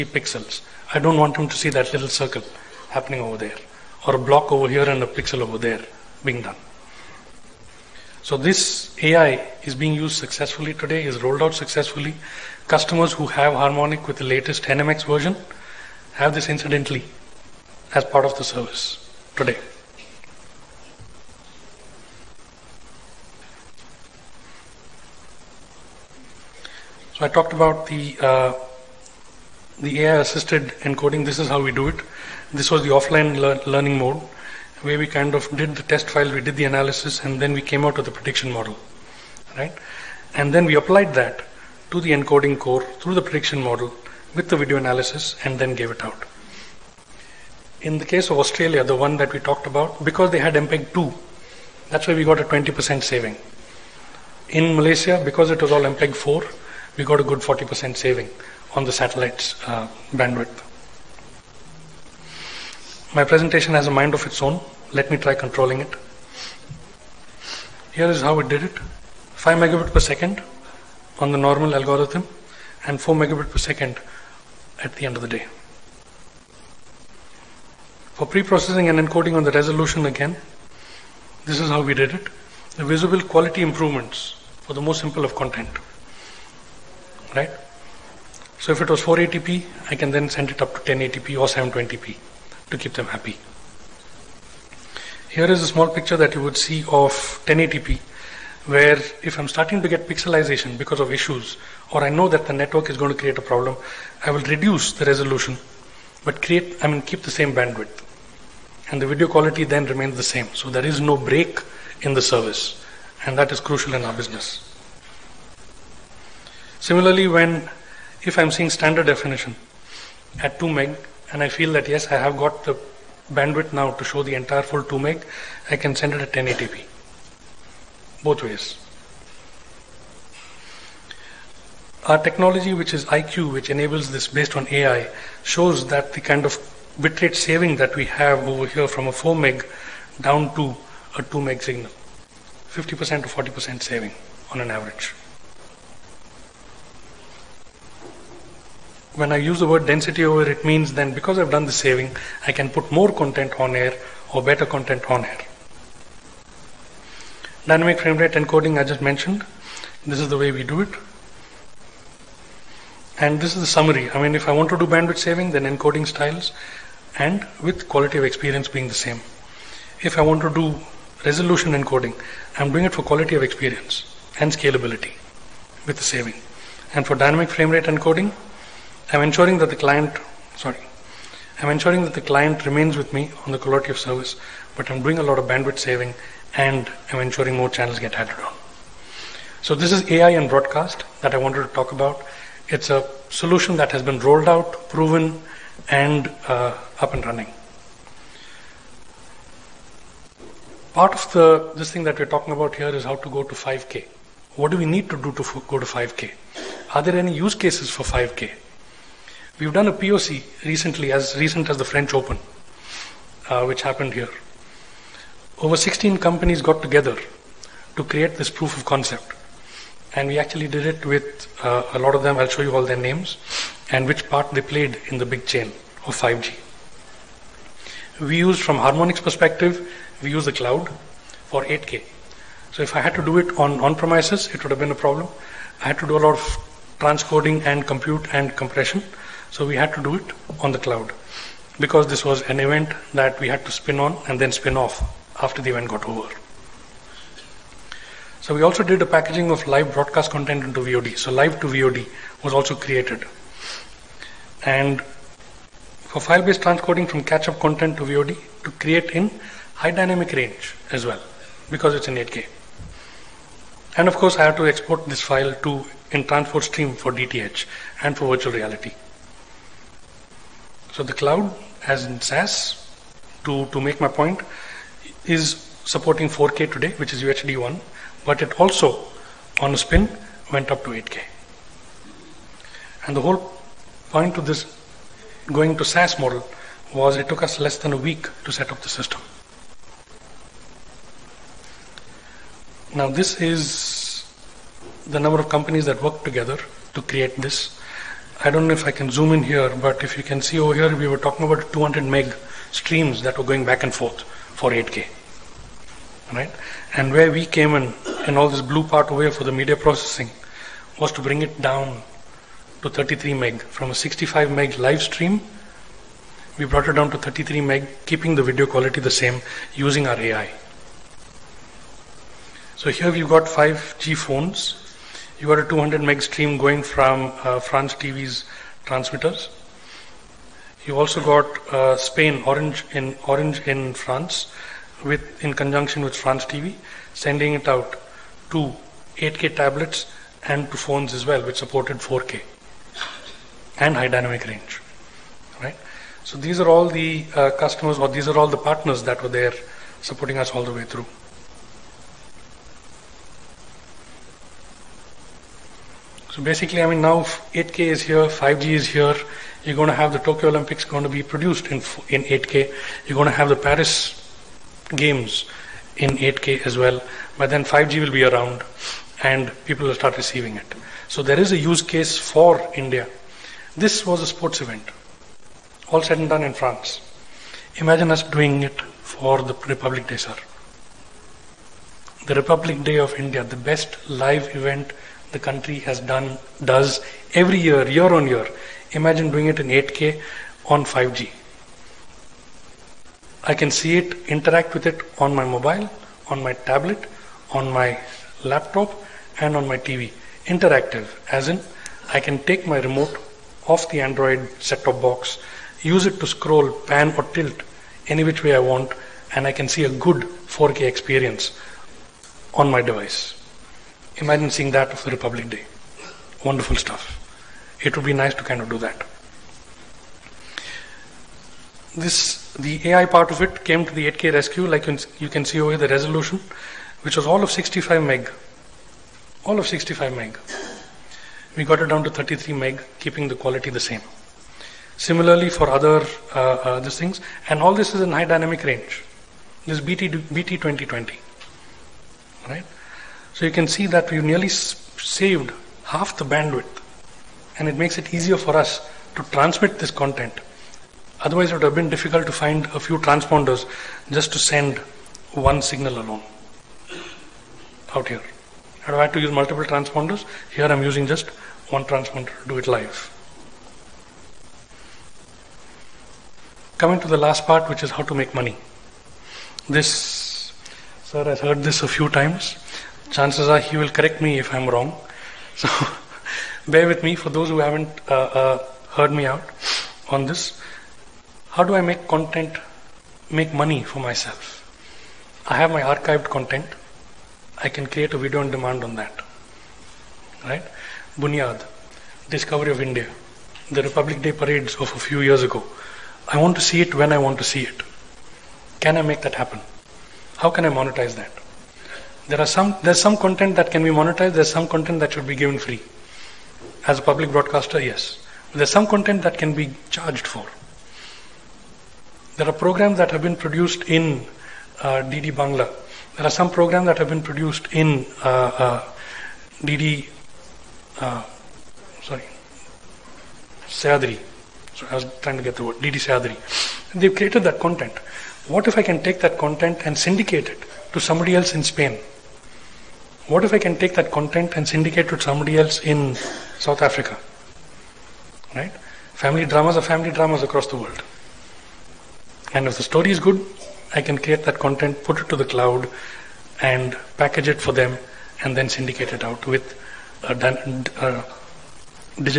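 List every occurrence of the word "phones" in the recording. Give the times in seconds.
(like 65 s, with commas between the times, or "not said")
324 s, 340 s.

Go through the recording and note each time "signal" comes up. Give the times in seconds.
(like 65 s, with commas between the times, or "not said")
141 s, 455 s.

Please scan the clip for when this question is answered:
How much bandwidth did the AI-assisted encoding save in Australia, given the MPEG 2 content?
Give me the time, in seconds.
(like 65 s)
52 s.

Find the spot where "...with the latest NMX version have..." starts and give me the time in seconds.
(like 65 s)
14 s.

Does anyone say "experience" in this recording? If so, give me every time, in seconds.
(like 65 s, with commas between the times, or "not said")
168 s, 173 s, 410 s.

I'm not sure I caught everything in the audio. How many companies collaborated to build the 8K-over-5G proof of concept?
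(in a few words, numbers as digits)
16.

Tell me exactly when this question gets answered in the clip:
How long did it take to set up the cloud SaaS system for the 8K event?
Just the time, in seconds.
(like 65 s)
287 s.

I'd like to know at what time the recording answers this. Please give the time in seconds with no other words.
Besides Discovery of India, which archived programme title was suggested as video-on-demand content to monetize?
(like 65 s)
491 s.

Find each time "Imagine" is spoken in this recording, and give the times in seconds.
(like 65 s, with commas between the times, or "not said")
377 s, 388 s, 414 s.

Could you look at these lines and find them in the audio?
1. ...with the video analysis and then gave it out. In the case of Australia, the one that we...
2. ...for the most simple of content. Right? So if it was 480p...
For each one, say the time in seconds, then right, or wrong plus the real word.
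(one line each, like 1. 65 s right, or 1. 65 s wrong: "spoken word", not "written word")
1. 44 s right
2. 84 s right.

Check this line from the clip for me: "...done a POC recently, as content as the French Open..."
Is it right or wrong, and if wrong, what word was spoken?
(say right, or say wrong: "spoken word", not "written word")
wrong: "recent", not "content".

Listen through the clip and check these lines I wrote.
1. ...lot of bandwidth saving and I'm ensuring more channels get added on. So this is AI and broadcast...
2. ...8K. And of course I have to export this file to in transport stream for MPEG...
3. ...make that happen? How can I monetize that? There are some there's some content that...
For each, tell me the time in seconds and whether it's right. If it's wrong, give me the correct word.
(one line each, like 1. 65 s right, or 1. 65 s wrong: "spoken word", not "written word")
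1. 185 s right
2. 262 s wrong: "DTH", not "MPEG"
3. 499 s right.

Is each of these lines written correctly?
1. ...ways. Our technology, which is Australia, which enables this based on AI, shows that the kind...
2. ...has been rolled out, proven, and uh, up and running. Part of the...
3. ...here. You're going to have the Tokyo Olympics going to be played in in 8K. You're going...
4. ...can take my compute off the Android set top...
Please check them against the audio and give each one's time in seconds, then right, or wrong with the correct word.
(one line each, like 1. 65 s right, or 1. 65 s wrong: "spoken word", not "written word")
1. 128 s wrong: "EyeQ", not "Australia"
2. 193 s right
3. 358 s wrong: "produced", not "played"
4. 402 s wrong: "remote", not "compute".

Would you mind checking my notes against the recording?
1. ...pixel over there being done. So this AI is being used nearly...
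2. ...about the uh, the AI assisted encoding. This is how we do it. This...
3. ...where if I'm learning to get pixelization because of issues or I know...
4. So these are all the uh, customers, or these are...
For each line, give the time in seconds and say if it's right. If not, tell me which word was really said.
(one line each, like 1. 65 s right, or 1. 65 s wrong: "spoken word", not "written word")
1. 5 s wrong: "successfully", not "nearly"
2. 27 s right
3. 98 s wrong: "starting", not "learning"
4. 346 s right.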